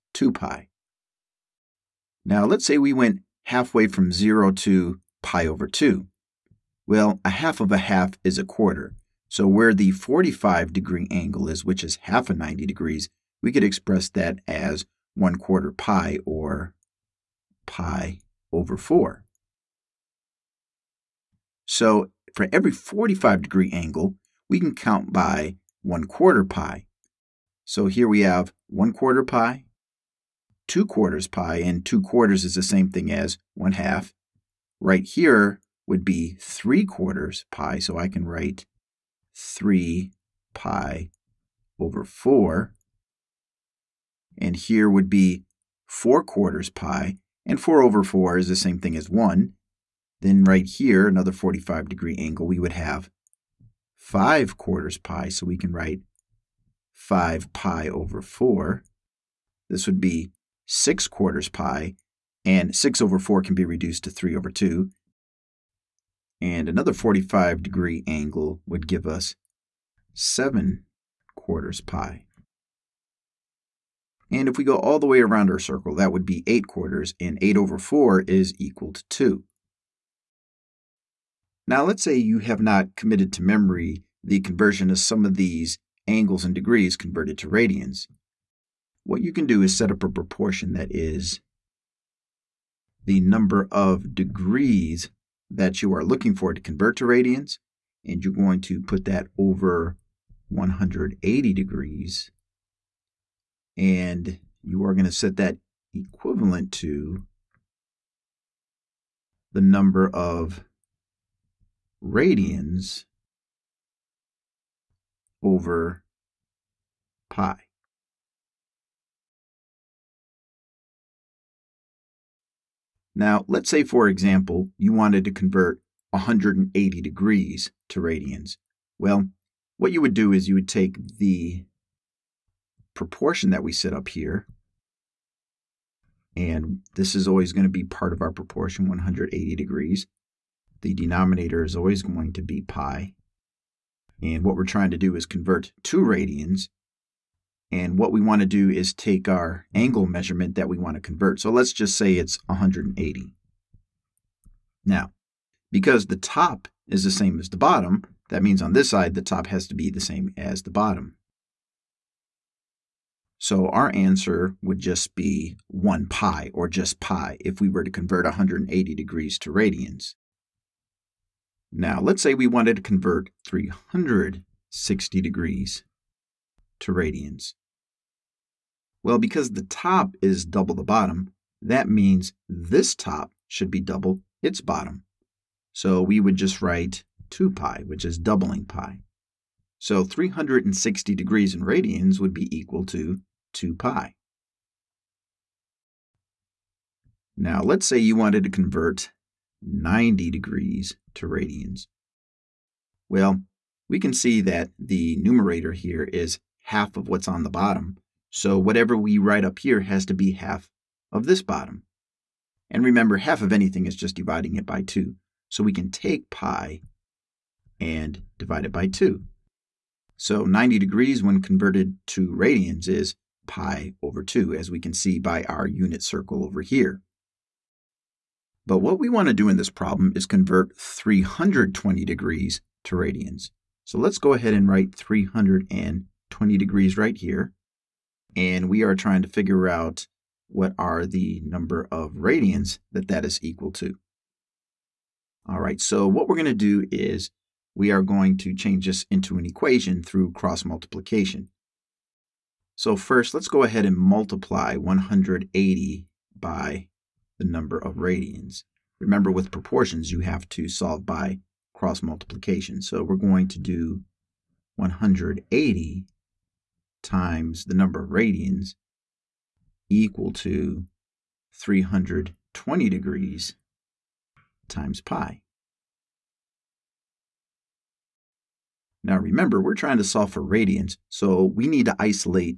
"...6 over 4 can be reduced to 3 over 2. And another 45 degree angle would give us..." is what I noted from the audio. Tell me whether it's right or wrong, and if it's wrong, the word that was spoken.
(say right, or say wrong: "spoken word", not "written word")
right.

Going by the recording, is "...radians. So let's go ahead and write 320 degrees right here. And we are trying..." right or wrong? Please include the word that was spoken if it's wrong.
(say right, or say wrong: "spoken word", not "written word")
right.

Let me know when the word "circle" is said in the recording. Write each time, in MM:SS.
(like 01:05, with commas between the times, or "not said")
01:15, 03:46.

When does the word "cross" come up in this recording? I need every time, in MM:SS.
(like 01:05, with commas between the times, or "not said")
04:10, 04:21.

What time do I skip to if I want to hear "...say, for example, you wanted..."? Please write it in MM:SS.
02:03.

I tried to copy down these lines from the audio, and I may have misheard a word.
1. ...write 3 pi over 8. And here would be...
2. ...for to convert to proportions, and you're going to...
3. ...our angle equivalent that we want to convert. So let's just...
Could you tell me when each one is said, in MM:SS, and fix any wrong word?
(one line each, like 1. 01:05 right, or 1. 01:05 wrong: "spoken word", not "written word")
1. 00:38 wrong: "4", not "8"
2. 01:36 wrong: "radians", not "proportions"
3. 02:29 wrong: "measurement", not "equivalent".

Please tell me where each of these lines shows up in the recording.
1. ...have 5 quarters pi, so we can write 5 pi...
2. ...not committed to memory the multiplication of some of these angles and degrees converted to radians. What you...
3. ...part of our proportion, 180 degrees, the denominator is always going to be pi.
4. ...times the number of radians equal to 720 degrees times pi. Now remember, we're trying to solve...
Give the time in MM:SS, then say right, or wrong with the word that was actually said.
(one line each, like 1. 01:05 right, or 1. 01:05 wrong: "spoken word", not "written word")
1. 00:52 right
2. 01:22 wrong: "conversion", not "multiplication"
3. 02:17 right
4. 04:27 wrong: "320", not "720".